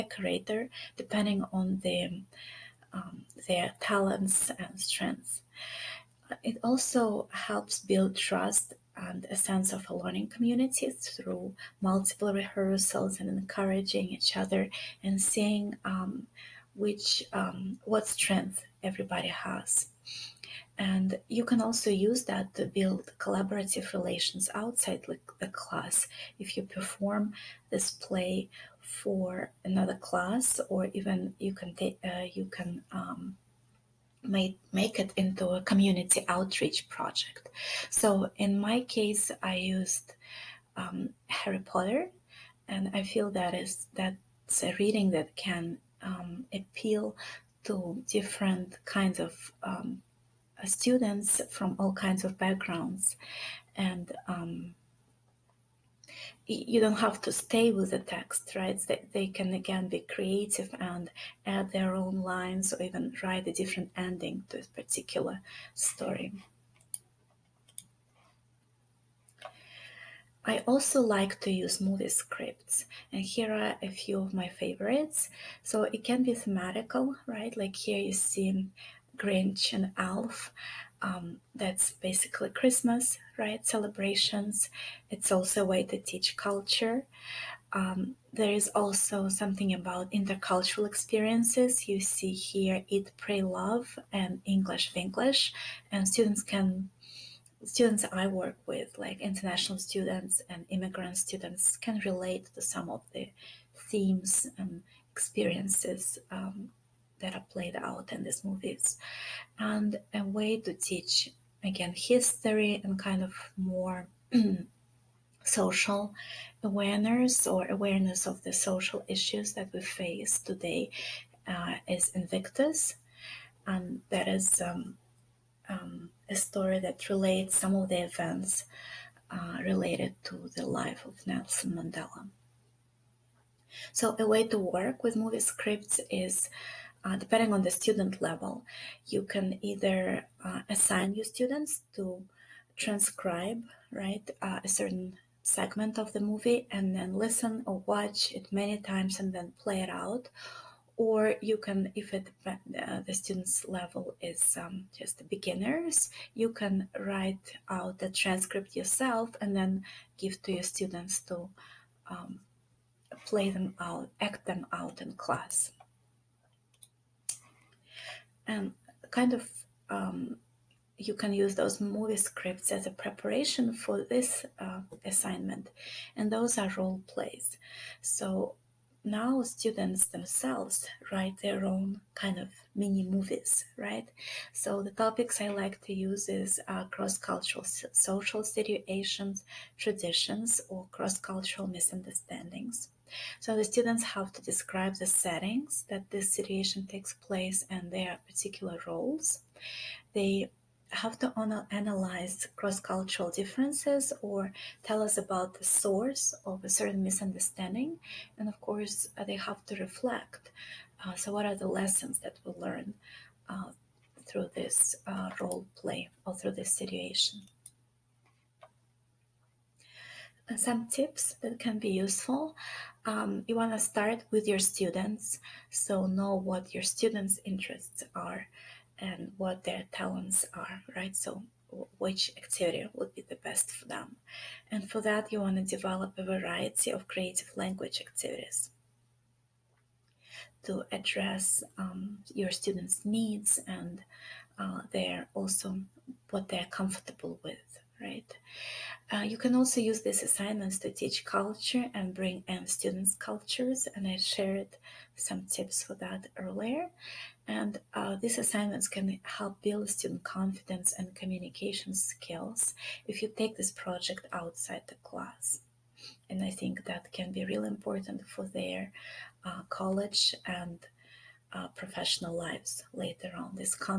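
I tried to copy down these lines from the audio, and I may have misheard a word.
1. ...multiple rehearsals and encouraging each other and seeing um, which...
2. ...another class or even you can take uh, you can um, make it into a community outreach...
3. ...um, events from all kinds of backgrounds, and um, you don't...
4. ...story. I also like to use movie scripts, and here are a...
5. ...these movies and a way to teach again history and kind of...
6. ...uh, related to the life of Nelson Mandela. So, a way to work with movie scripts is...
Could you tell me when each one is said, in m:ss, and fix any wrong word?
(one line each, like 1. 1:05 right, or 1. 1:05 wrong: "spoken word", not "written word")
1. 0:11 right
2. 0:29 right
3. 0:49 wrong: "students", not "events"
4. 1:05 right
5. 1:48 right
6. 2:09 right.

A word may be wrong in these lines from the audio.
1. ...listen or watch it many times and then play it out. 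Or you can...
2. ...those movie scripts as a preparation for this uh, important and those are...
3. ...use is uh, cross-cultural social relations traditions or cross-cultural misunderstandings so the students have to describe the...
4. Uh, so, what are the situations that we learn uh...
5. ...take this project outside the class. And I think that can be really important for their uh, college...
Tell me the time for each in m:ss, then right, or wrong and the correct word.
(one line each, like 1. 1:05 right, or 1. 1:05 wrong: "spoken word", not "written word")
1. 2:27 right
2. 2:51 wrong: "assignment", not "important"
3. 3:05 wrong: "situations", not "relations"
4. 3:31 wrong: "lessons", not "situations"
5. 4:23 right.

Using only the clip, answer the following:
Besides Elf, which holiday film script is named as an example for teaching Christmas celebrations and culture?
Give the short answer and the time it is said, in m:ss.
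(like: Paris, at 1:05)
Grinch, at 1:19.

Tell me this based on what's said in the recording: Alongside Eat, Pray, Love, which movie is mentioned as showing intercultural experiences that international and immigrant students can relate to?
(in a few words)
English Vinglish.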